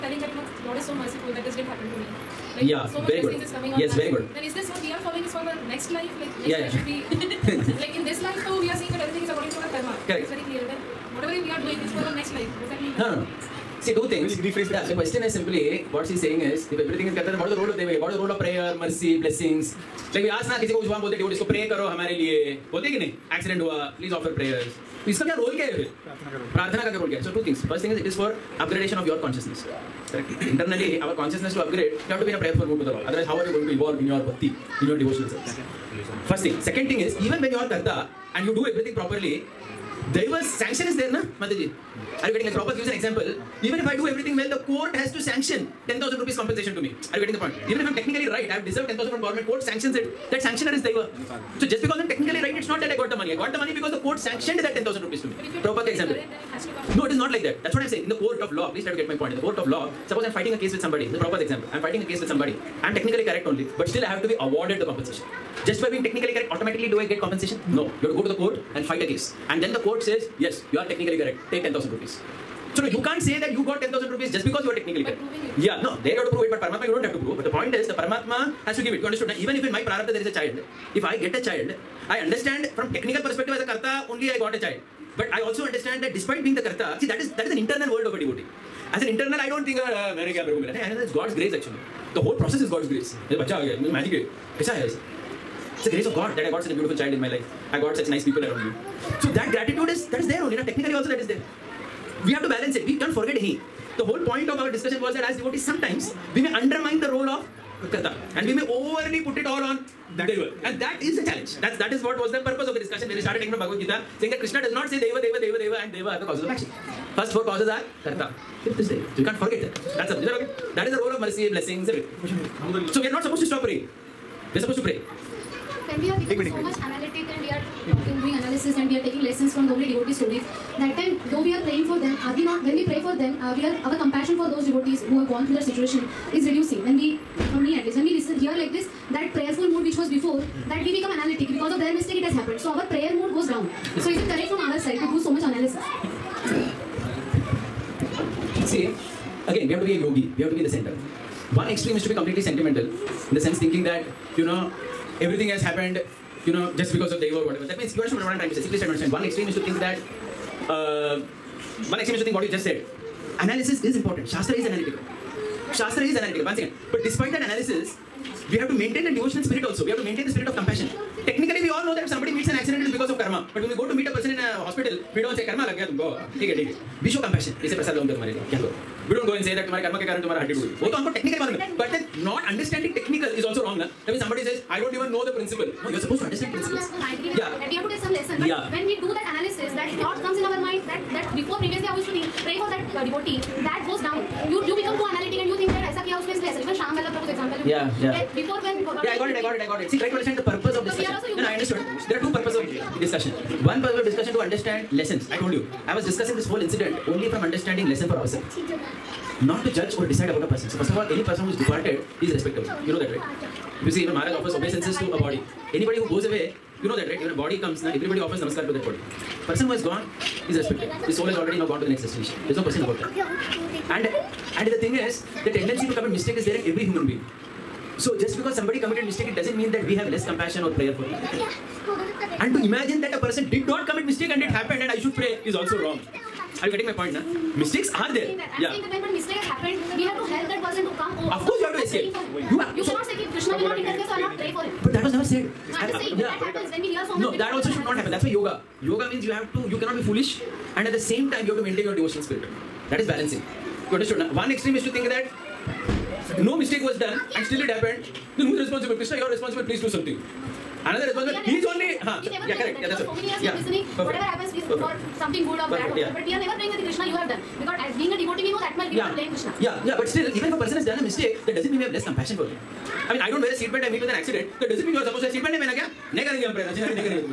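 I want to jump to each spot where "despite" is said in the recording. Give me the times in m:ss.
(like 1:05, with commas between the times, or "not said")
1:26, 2:47.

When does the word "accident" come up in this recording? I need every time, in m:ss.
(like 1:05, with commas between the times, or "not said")
2:52, 4:34.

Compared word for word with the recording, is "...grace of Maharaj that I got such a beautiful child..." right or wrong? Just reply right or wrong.
wrong.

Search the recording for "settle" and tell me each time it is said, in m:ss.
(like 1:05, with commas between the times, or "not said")
not said.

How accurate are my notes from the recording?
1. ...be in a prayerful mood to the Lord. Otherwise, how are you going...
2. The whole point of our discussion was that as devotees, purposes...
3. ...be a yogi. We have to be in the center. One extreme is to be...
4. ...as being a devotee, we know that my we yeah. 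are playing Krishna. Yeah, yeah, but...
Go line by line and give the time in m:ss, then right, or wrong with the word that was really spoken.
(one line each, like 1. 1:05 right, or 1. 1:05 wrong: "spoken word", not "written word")
1. 0:32 right
2. 1:43 wrong: "sometimes", not "purposes"
3. 2:29 right
4. 4:27 right.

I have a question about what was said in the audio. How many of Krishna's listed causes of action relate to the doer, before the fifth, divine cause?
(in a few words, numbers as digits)
4.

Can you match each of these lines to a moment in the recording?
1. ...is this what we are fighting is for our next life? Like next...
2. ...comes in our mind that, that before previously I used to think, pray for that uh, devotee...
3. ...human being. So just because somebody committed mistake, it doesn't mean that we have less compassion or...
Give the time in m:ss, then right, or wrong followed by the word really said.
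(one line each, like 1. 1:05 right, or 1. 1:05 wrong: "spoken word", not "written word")
1. 0:04 wrong: "following", not "fighting"
2. 3:10 right
3. 3:46 right.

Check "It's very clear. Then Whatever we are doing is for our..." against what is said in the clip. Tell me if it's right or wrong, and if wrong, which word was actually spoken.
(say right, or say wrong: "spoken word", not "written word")
right.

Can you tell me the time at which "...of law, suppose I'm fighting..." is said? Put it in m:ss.
0:59.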